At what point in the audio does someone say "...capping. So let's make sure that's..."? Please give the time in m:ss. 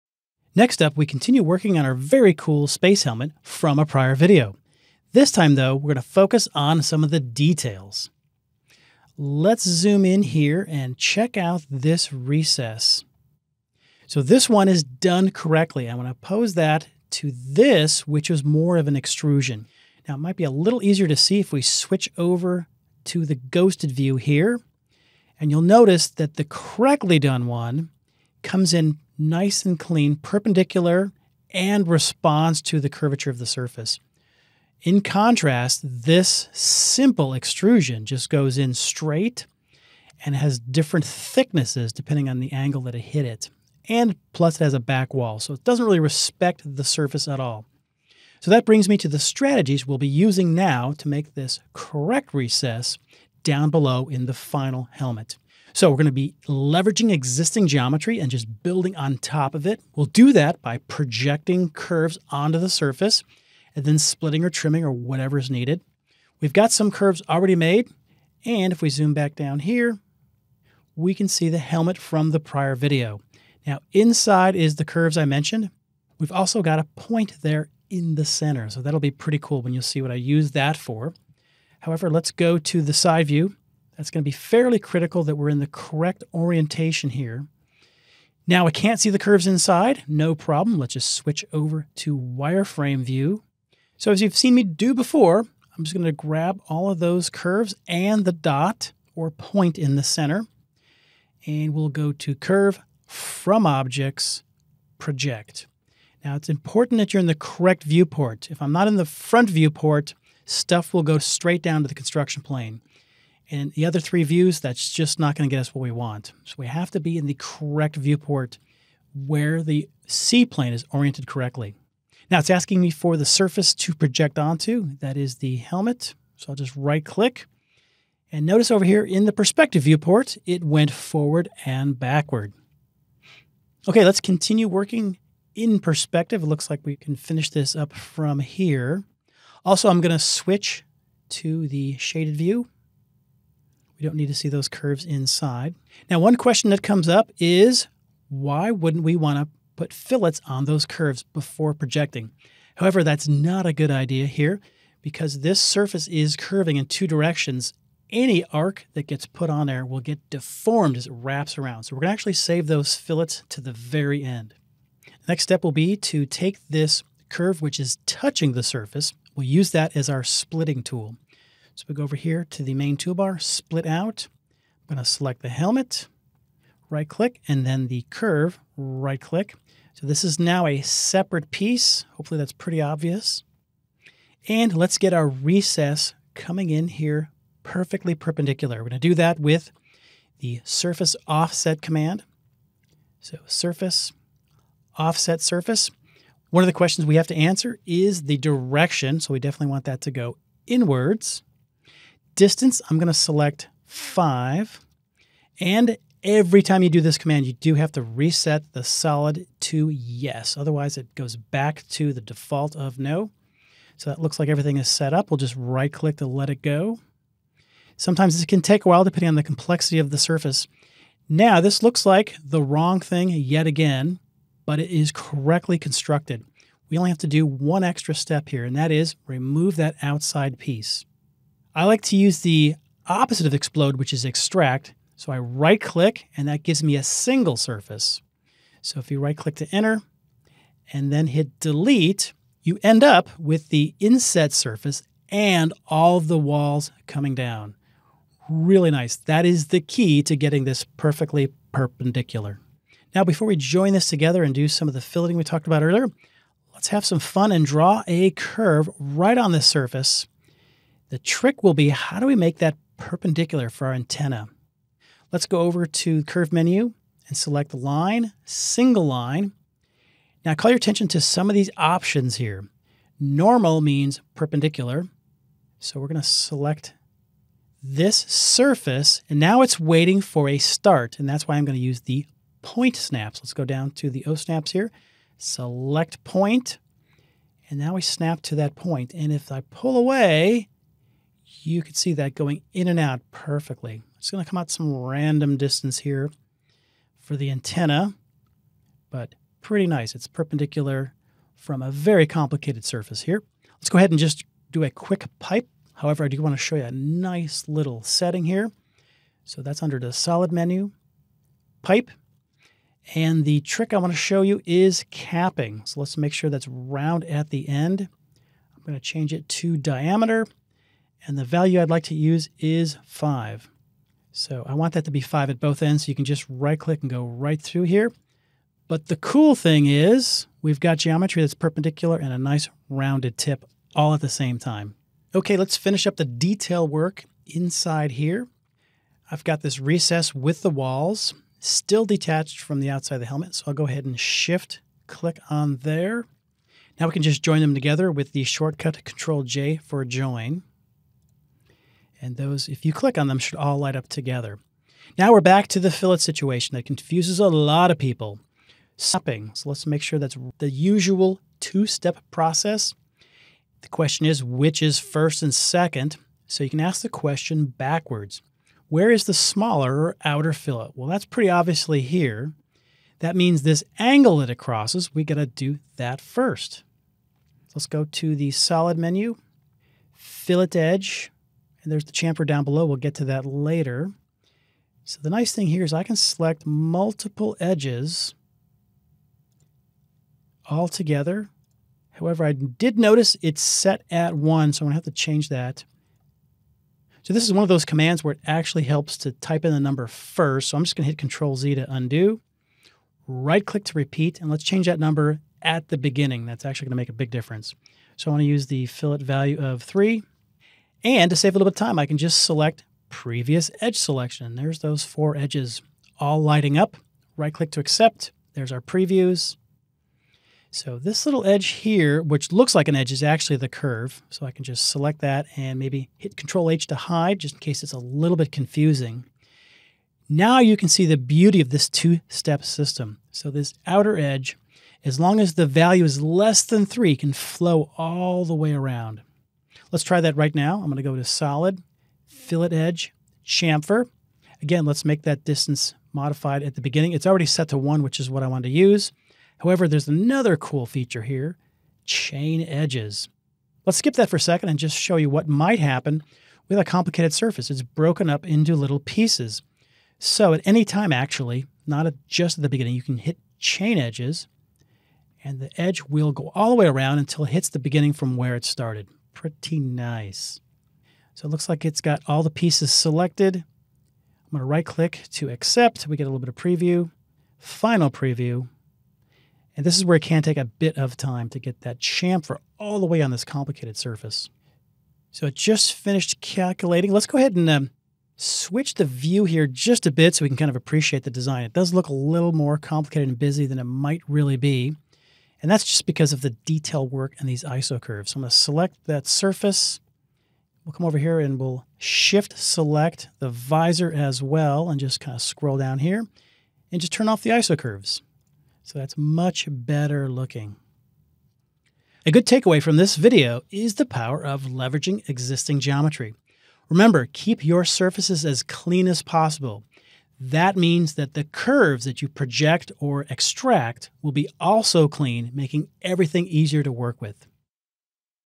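5:15.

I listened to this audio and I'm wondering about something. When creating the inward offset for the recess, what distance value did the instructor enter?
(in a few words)
5.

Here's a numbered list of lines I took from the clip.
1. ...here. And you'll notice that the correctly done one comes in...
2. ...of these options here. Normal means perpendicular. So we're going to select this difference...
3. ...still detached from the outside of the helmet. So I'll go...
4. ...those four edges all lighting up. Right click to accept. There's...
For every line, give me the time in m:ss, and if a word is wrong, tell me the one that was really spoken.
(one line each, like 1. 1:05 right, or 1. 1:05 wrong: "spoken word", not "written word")
1. 0:24 right
2. 4:31 wrong: "surface", not "difference"
3. 5:41 right
4. 6:54 right.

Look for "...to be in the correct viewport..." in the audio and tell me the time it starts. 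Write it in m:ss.
1:56.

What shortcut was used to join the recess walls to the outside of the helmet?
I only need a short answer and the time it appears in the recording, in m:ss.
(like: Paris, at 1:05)
Control J, at 5:49.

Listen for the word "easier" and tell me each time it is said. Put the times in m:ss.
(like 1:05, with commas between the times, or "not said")
0:20, 8:46.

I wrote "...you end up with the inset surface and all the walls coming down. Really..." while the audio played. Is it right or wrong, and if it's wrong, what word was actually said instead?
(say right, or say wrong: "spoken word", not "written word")
right.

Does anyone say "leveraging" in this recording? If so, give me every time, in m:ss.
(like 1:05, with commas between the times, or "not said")
0:56, 8:34.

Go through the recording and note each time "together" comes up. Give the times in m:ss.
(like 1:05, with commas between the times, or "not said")
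4:14, 5:47, 5:54, 6:30.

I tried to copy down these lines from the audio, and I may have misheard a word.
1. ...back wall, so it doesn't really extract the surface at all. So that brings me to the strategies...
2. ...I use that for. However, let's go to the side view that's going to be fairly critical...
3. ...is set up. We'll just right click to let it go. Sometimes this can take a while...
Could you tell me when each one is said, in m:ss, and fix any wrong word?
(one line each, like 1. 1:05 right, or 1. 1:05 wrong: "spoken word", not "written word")
1. 0:44 wrong: "respect", not "extract"
2. 1:20 right
3. 3:34 right.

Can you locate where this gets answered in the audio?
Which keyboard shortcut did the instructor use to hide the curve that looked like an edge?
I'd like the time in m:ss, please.
7:06.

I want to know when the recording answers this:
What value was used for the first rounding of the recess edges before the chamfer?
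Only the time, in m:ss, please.
6:48.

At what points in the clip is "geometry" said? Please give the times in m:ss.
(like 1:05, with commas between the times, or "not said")
0:57, 5:30, 8:35.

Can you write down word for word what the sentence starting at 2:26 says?
Now, one question that comes up is why wouldn't we want to put fillets on those curves before projecting?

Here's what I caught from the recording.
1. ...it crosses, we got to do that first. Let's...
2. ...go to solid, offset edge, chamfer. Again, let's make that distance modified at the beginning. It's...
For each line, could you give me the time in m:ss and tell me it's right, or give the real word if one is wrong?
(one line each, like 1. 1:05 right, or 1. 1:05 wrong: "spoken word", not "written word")
1. 6:14 right
2. 7:21 wrong: "fillet", not "offset".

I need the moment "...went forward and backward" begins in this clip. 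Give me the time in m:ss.
2:10.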